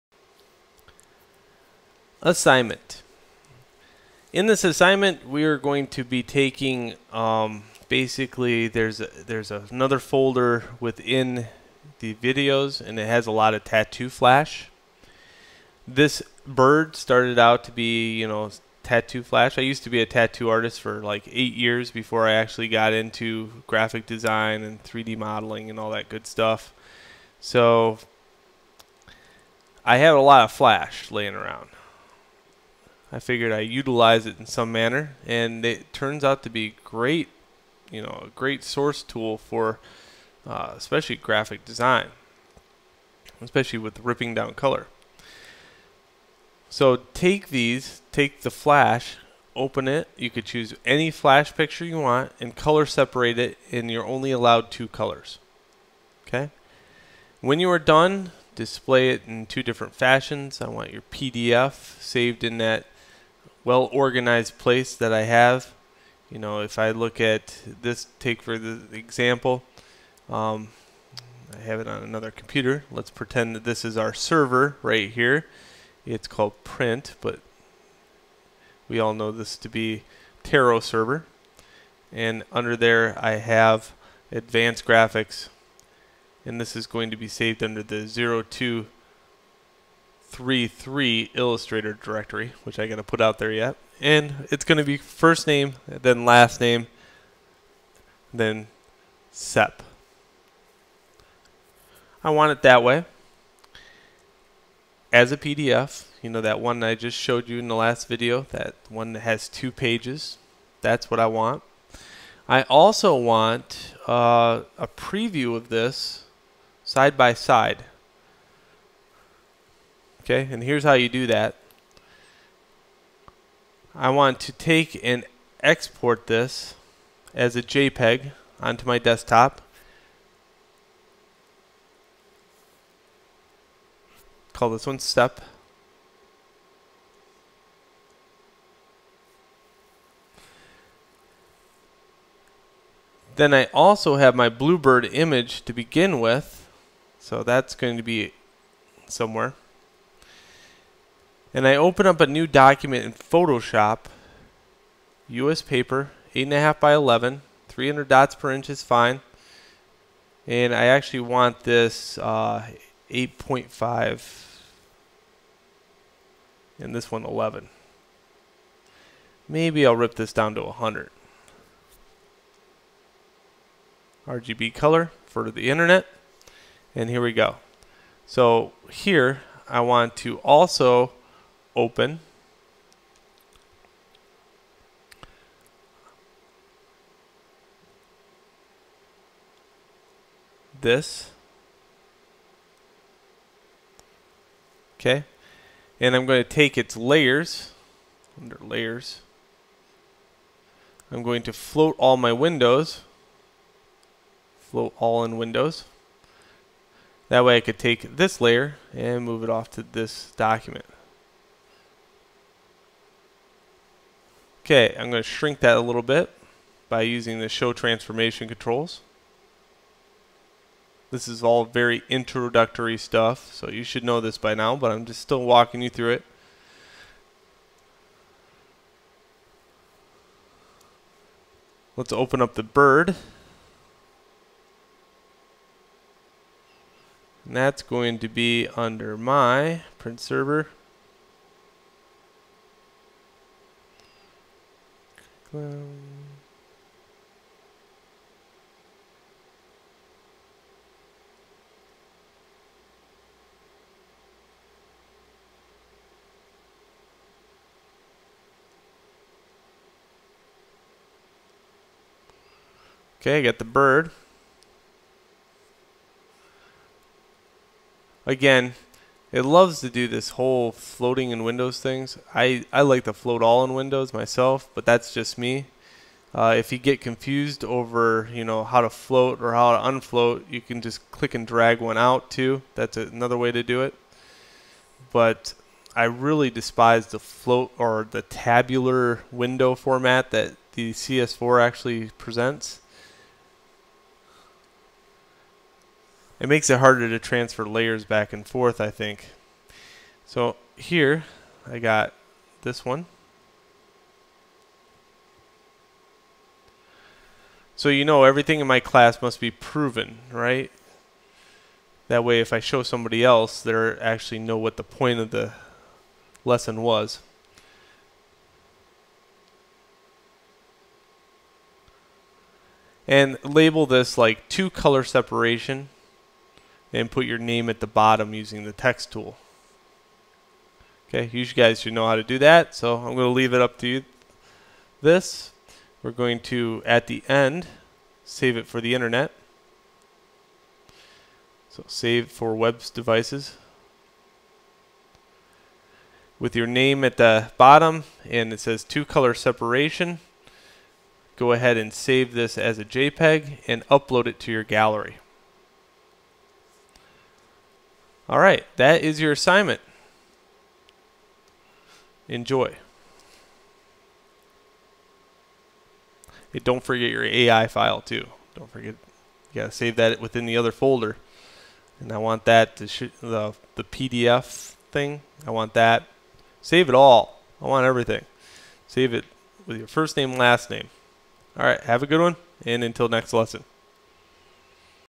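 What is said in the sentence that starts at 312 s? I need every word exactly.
That way if I show somebody else, they actually know what the point of the lesson was.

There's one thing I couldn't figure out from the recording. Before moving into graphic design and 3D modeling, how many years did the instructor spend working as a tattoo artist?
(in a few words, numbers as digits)
8.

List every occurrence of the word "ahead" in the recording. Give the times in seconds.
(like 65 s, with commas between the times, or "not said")
351 s.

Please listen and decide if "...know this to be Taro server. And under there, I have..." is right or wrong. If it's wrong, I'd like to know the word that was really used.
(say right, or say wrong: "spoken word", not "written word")
right.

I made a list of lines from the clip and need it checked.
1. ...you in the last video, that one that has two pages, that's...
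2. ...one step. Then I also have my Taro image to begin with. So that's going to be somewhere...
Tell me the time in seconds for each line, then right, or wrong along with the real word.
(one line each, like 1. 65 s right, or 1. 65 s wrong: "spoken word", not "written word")
1. 107 s right
2. 134 s wrong: "Bluebird", not "Taro".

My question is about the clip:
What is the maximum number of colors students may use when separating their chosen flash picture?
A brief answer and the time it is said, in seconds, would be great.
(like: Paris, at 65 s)
2, at 54 s.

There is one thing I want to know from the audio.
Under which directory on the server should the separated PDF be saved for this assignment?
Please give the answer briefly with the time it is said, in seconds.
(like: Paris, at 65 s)
02 3.3 Illustrator, at 88 s.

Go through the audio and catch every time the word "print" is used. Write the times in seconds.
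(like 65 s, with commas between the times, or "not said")
76 s, 239 s.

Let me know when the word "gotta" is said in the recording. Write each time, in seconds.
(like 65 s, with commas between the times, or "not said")
92 s, 369 s.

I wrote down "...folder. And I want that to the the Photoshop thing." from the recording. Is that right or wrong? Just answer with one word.
wrong.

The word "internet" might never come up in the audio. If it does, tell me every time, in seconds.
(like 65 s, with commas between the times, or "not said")
175 s, 338 s.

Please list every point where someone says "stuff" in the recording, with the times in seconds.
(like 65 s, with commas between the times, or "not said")
26 s, 222 s.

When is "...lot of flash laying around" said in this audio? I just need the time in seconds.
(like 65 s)
30 s.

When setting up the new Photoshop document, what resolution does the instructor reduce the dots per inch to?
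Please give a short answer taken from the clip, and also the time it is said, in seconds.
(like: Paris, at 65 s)
100, at 170 s.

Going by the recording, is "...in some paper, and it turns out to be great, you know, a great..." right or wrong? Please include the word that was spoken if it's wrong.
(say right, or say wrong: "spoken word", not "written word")
wrong: "manner", not "paper".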